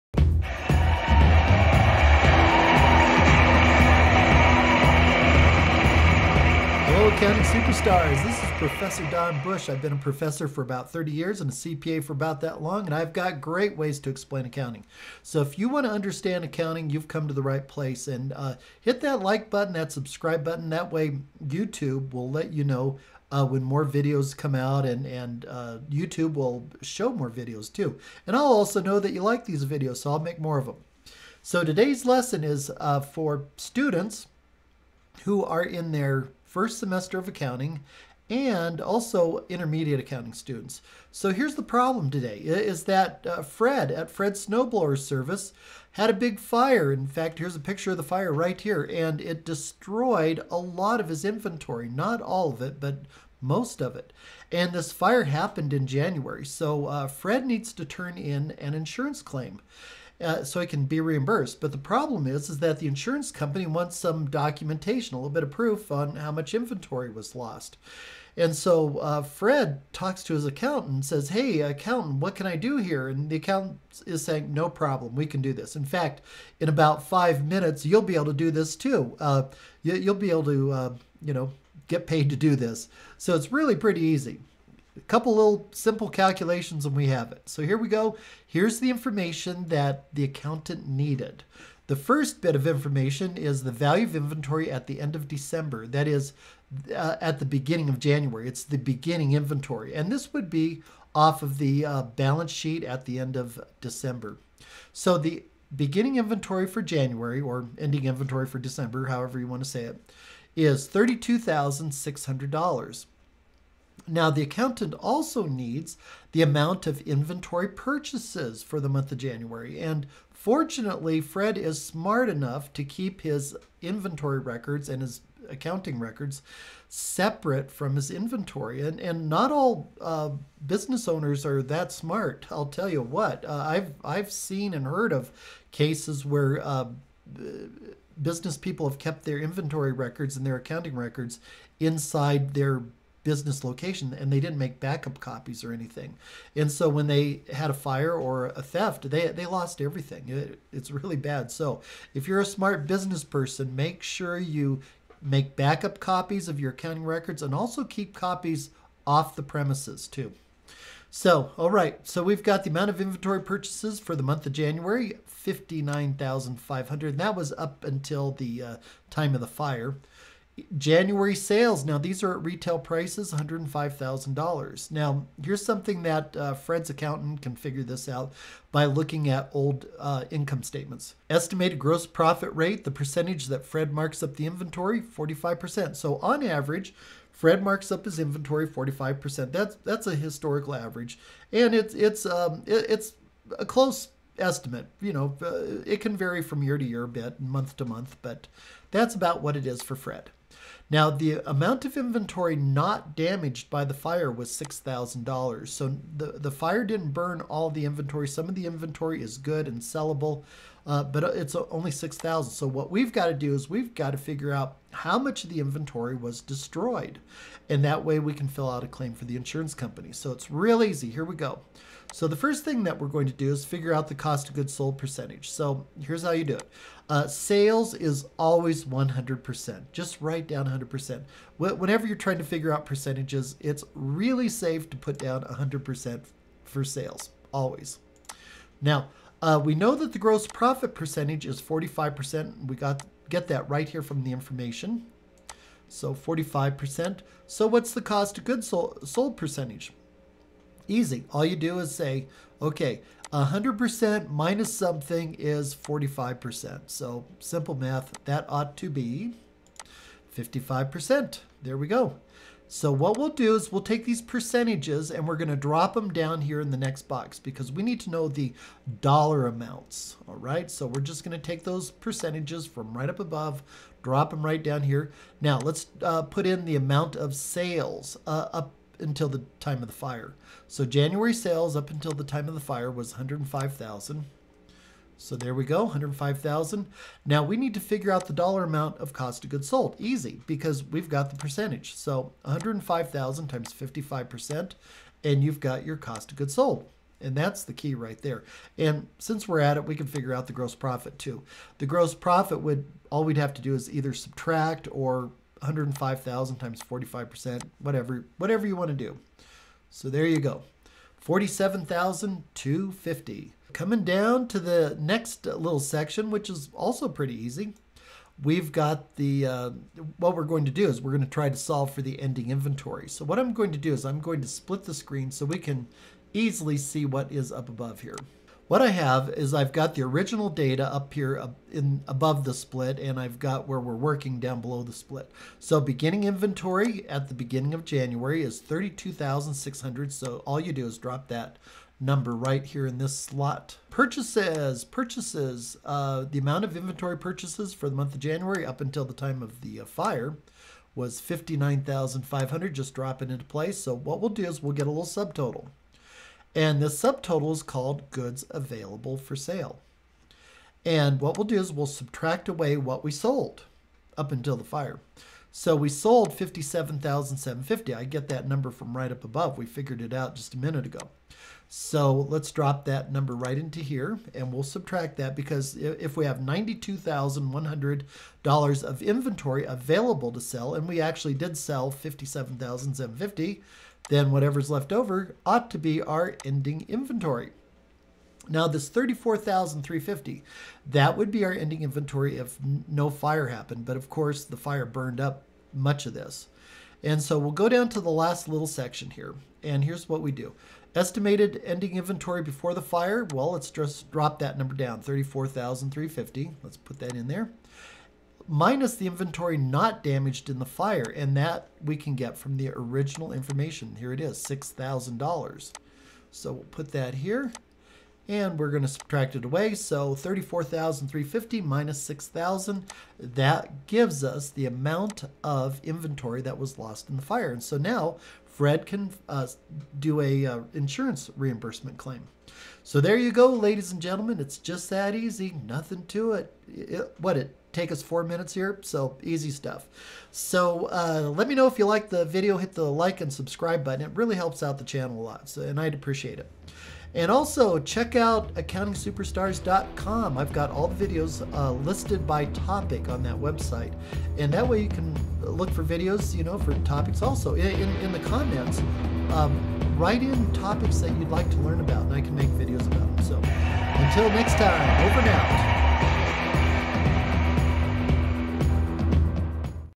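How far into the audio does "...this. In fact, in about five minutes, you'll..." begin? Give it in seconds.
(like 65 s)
75 s.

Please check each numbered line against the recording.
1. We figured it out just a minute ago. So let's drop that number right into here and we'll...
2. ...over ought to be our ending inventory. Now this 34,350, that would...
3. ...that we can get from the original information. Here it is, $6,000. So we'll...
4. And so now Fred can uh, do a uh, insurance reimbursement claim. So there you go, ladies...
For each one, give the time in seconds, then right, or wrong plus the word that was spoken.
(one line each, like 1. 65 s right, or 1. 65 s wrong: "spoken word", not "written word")
1. 369 s right
2. 384 s right
3. 411 s right
4. 427 s right.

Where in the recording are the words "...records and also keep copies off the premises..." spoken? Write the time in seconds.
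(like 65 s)
157 s.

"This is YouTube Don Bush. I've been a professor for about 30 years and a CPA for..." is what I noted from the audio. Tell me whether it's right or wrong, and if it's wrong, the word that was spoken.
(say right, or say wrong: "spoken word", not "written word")
wrong: "Professor", not "YouTube".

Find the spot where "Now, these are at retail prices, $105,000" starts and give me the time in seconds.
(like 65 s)
171 s.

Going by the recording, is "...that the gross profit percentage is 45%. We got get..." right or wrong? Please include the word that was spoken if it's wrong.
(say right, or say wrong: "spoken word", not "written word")
right.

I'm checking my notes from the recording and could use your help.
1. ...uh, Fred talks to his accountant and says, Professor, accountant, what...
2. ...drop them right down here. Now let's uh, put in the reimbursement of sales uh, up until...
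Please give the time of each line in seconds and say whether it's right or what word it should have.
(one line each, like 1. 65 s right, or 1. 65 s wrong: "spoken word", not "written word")
1. 68 s wrong: "Hey", not "Professor"
2. 274 s wrong: "amount", not "reimbursement".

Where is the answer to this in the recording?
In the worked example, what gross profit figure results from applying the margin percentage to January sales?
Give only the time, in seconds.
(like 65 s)
311 s.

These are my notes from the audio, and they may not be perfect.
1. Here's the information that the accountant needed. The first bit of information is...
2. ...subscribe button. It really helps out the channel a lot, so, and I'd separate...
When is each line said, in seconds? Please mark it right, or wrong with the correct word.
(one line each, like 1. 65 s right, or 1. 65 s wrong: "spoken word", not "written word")
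1. 88 s right
2. 443 s wrong: "appreciate", not "separate".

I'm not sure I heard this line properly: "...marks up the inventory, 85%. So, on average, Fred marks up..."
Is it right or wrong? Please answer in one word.
wrong.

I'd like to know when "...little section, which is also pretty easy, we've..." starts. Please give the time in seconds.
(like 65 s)
315 s.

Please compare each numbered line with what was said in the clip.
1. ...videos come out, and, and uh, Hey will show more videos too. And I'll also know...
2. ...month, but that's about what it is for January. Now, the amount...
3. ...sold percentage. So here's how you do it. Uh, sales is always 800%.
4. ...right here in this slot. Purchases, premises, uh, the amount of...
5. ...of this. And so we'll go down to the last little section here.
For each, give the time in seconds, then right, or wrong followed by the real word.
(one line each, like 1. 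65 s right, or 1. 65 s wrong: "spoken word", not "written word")
1. 23 s wrong: "YouTube", not "Hey"
2. 197 s wrong: "Fred", not "January"
3. 224 s wrong: "100", not "800"
4. 342 s wrong: "purchases", not "premises"
5. 396 s right.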